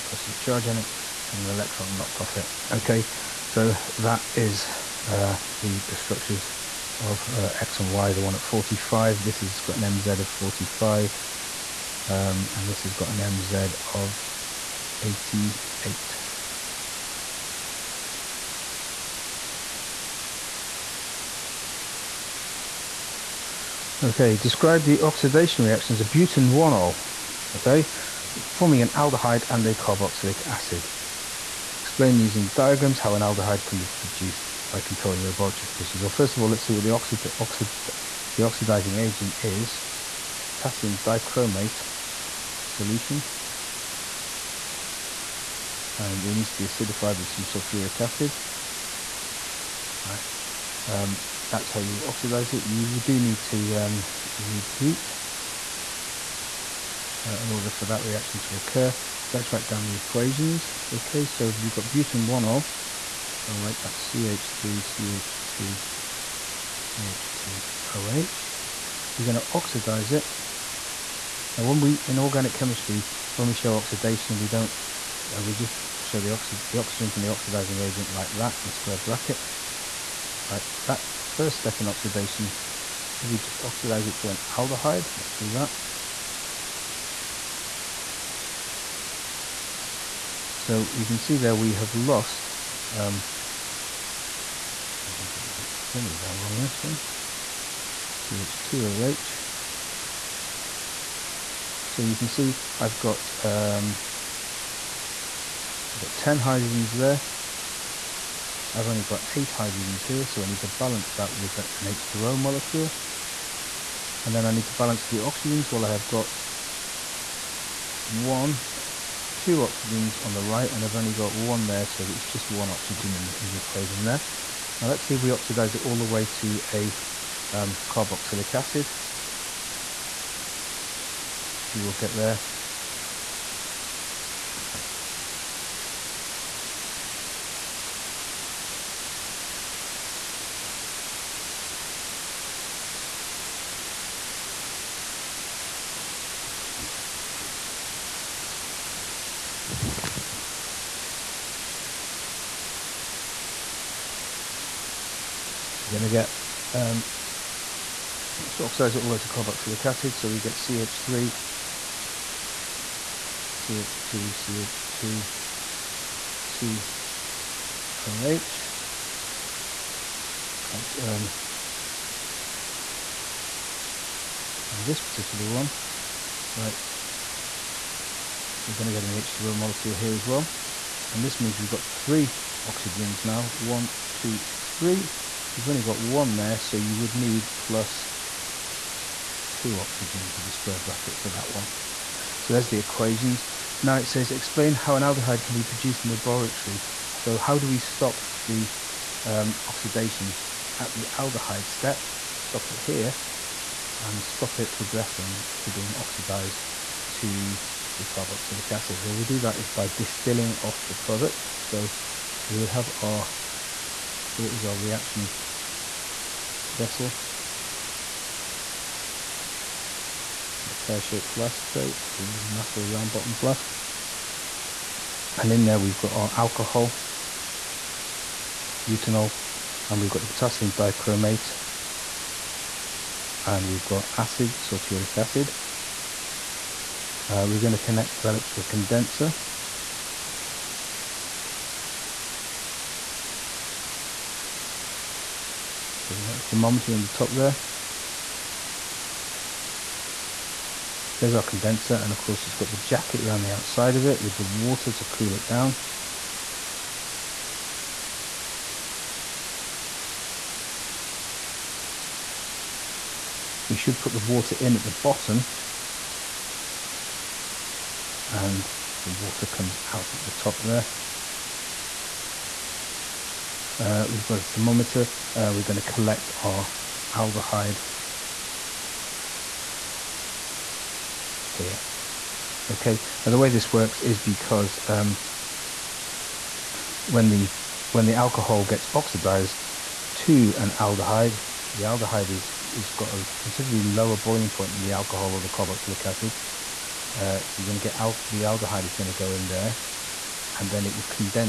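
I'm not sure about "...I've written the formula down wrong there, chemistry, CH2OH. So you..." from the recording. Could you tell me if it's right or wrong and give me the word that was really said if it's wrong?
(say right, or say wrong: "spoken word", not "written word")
wrong: "sorry", not "chemistry".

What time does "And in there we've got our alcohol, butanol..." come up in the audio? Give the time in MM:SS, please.
03:45.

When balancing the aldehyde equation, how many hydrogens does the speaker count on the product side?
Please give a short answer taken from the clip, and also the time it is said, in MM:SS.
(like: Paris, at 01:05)
8, at 01:49.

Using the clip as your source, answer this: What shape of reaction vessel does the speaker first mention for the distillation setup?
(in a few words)
pear-shaped flask.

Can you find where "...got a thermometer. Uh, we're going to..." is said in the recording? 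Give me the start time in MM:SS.
04:34.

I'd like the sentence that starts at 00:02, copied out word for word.
Okay, so that is uh, the, the structures of uh, X and Y, the one at 45.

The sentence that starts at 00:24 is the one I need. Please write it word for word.
Okay, describe the oxidation reactions of butan-1-ol.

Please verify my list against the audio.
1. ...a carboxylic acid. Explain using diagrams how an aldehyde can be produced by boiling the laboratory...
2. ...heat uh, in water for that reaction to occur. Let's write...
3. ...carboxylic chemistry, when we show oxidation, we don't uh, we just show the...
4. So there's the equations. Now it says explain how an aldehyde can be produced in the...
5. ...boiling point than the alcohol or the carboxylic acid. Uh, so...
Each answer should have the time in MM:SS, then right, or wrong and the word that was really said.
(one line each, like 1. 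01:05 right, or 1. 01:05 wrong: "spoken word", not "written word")
1. 00:29 wrong: "controlling", not "boiling"
2. 00:54 wrong: "order", not "water"
3. 01:12 wrong: "organic", not "carboxylic"
4. 03:12 right
5. 04:54 right.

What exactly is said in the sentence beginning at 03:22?
Stop it here and stop it progressing to being oxidized to the carboxylic acid.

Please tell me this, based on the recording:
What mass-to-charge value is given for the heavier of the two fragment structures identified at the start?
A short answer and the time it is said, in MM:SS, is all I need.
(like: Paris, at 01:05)
88, at 00:15.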